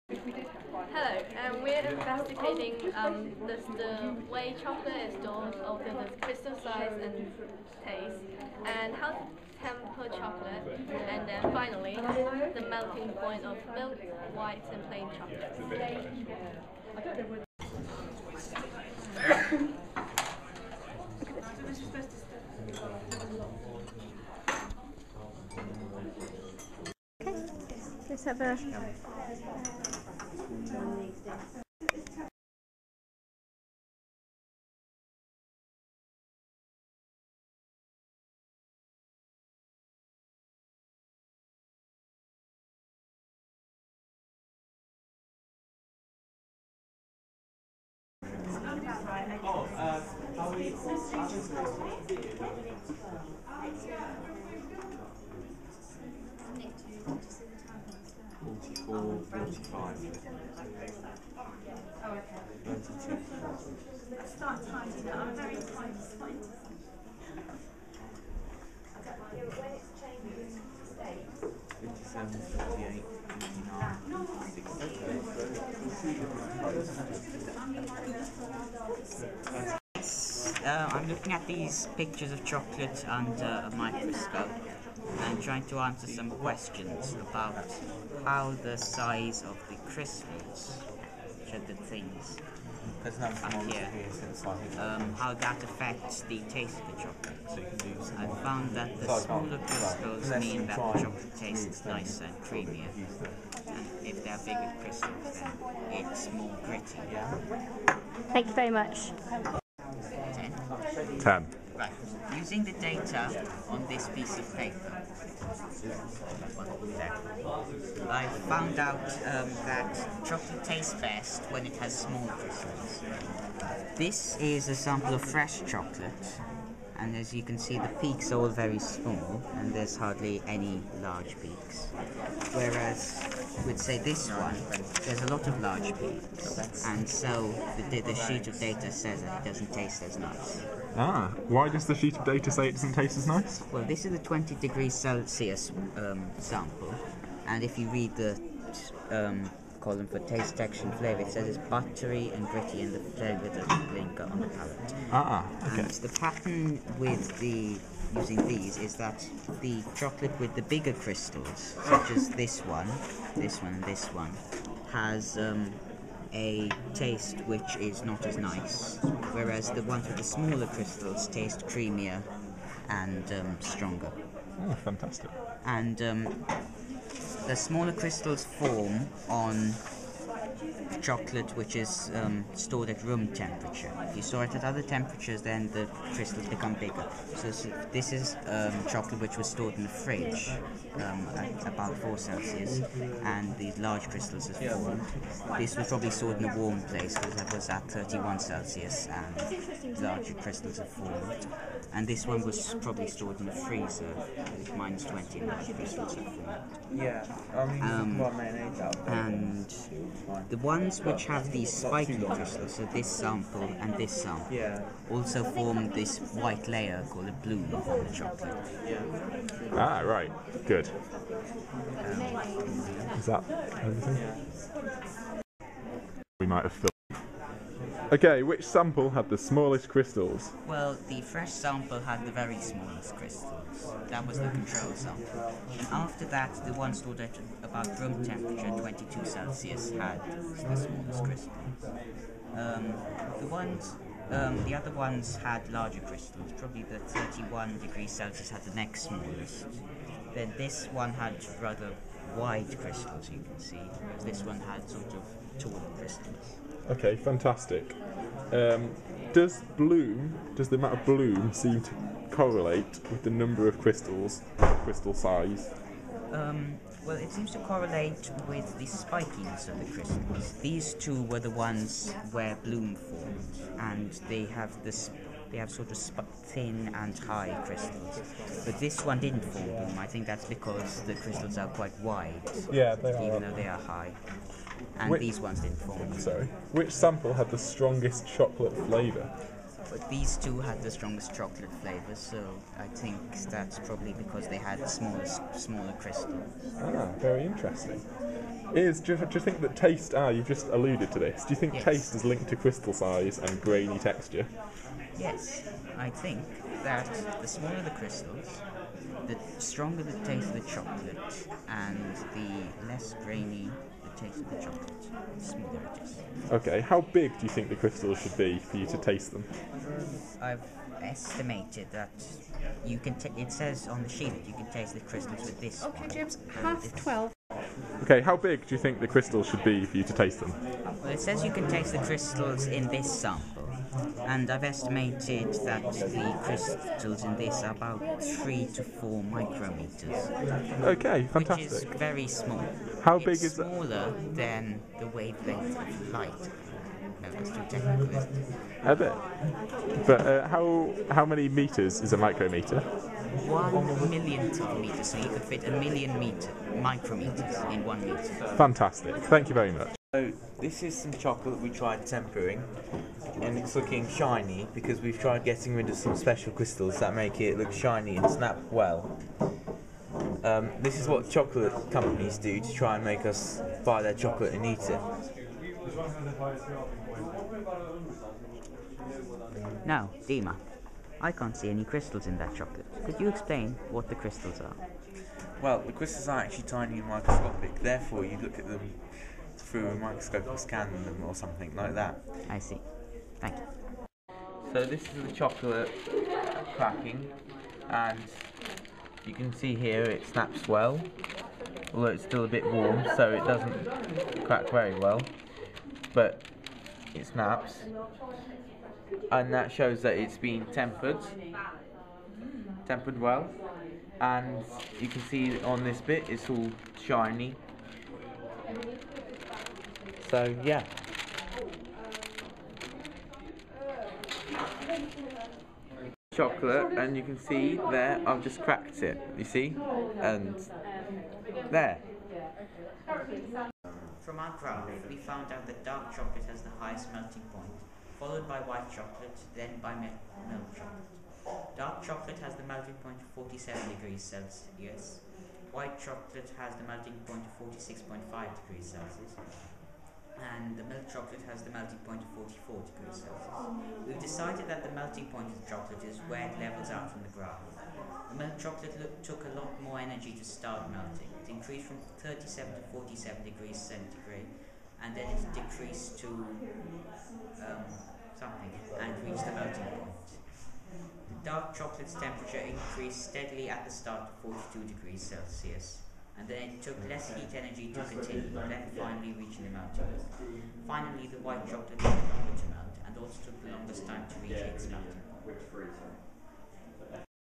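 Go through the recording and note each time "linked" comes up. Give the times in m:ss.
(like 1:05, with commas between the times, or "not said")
5:02.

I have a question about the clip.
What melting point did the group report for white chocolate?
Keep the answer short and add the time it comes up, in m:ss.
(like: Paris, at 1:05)
46.5 degrees Celsius, at 7:27.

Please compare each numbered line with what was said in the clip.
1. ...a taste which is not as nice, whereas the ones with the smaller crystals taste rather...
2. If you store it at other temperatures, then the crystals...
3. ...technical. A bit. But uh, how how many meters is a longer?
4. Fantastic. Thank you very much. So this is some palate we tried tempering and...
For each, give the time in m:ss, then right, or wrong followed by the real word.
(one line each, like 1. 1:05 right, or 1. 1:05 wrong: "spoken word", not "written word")
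1. 2:46 wrong: "creamier", not "rather"
2. 3:04 right
3. 5:47 wrong: "micrometer", not "longer"
4. 5:58 wrong: "chocolate", not "palate".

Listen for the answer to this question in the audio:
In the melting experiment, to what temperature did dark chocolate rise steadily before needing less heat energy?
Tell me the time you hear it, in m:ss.
7:54.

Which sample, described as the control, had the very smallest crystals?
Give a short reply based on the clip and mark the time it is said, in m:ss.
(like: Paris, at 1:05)
the fresh sample, at 3:51.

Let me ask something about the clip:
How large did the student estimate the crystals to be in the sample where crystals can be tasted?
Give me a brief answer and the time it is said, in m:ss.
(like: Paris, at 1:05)
3 to 4 micrometers, at 5:38.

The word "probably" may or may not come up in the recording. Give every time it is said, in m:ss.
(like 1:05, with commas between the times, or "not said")
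3:15, 3:22, 4:06, 4:53.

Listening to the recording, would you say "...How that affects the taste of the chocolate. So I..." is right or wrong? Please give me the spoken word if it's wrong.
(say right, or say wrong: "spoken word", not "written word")
right.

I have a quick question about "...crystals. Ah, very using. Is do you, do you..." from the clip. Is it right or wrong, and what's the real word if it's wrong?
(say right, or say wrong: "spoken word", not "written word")
wrong: "interesting", not "using".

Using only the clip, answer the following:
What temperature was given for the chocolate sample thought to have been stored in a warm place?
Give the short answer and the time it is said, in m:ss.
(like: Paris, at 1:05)
31 Celsius, at 3:17.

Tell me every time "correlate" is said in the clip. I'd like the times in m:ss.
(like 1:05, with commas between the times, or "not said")
4:22, 4:27.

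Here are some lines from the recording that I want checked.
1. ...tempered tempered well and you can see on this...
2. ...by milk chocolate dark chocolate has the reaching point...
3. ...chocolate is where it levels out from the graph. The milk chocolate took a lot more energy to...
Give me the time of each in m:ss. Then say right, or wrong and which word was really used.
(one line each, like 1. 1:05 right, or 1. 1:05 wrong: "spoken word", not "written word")
1. 6:50 right
2. 7:19 wrong: "melting", not "reaching"
3. 7:35 right.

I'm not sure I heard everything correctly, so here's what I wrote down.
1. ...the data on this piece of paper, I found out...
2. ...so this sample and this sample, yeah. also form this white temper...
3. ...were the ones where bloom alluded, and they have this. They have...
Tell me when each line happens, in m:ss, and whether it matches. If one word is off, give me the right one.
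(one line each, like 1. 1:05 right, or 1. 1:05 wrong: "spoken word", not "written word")
1. 1:52 right
2. 3:32 wrong: "layer", not "temper"
3. 4:31 wrong: "formed", not "alluded".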